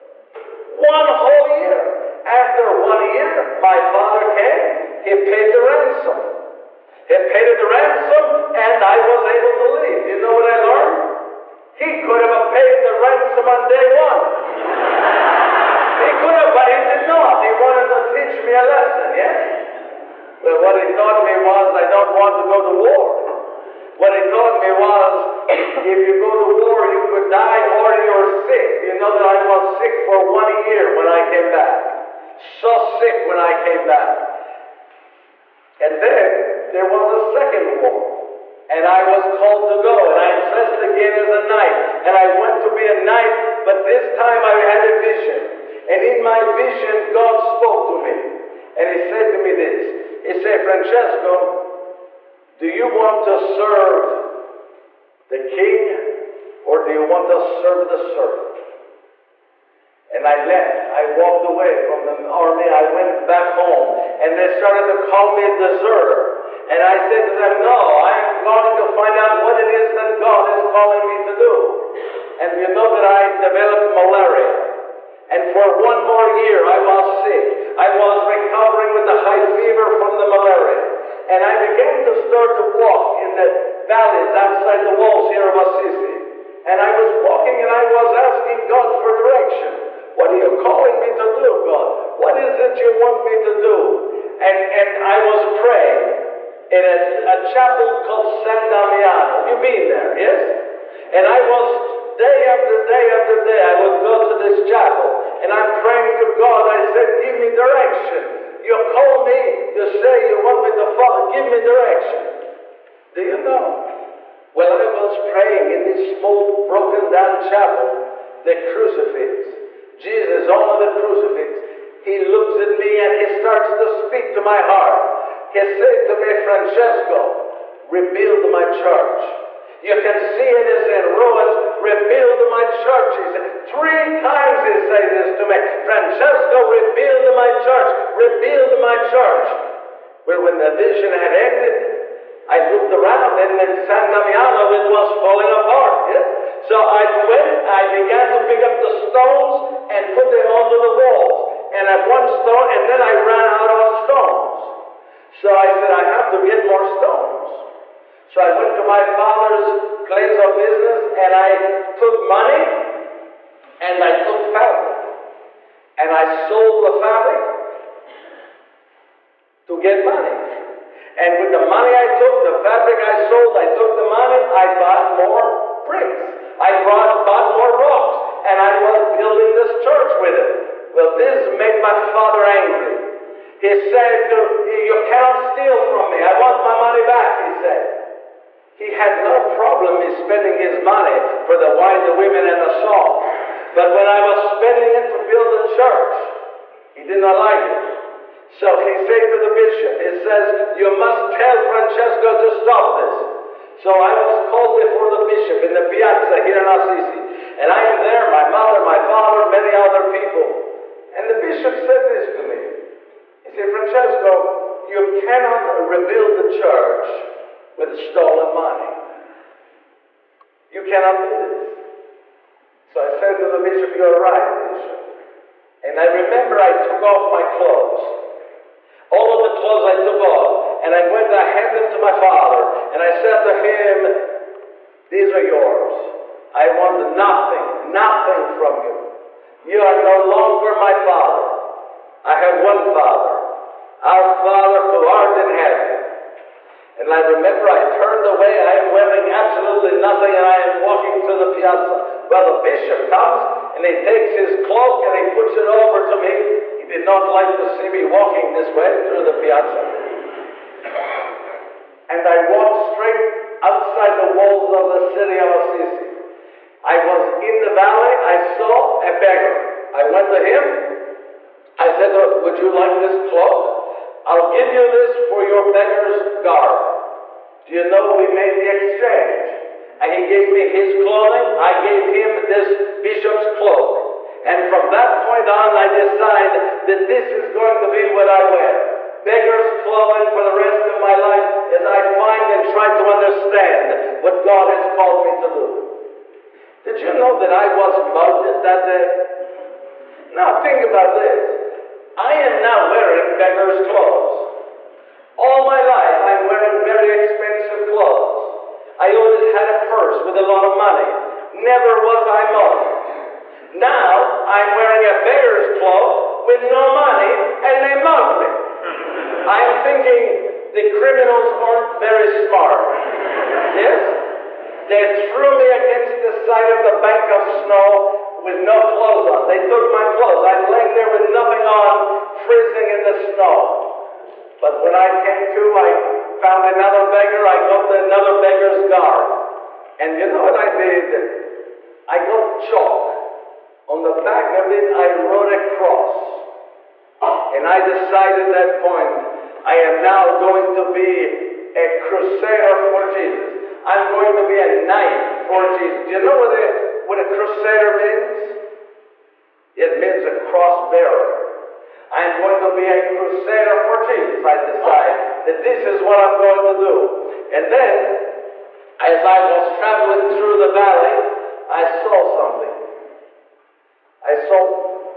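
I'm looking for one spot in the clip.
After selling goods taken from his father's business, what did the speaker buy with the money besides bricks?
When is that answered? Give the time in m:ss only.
2:57.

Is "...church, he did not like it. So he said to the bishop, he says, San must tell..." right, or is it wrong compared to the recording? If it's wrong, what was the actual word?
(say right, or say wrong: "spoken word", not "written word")
wrong: "You", not "San".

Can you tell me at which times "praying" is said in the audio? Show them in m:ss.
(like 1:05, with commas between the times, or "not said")
1:35, 1:45, 1:55.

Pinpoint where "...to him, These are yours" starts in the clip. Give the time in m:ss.
3:53.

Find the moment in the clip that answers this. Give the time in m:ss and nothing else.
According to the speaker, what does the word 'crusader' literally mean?
6:00.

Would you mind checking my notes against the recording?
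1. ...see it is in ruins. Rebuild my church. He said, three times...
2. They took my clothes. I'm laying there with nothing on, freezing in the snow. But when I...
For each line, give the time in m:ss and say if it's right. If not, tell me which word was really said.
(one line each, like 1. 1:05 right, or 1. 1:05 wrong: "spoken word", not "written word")
1. 2:10 right
2. 5:29 right.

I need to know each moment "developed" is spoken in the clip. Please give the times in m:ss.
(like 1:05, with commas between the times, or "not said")
1:13.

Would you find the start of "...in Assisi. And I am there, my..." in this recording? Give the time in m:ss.
3:26.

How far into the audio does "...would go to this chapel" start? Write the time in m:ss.
1:43.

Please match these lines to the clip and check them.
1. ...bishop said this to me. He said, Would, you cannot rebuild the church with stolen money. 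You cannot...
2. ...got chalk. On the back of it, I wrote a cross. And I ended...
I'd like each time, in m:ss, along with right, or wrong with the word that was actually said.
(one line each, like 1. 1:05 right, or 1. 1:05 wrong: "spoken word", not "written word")
1. 3:31 wrong: "Francesco", not "Would"
2. 5:42 wrong: "decided", not "ended".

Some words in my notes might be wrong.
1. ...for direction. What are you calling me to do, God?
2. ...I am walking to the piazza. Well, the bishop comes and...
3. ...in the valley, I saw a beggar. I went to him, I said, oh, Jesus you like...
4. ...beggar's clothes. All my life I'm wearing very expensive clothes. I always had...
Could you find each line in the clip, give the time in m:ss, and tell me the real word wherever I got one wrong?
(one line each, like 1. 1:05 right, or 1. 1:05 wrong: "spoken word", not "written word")
1. 1:29 right
2. 4:10 right
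3. 4:27 wrong: "Would", not "Jesus"
4. 5:03 right.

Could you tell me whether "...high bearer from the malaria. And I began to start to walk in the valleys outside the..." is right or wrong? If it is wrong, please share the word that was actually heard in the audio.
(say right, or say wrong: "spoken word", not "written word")
wrong: "fever", not "bearer".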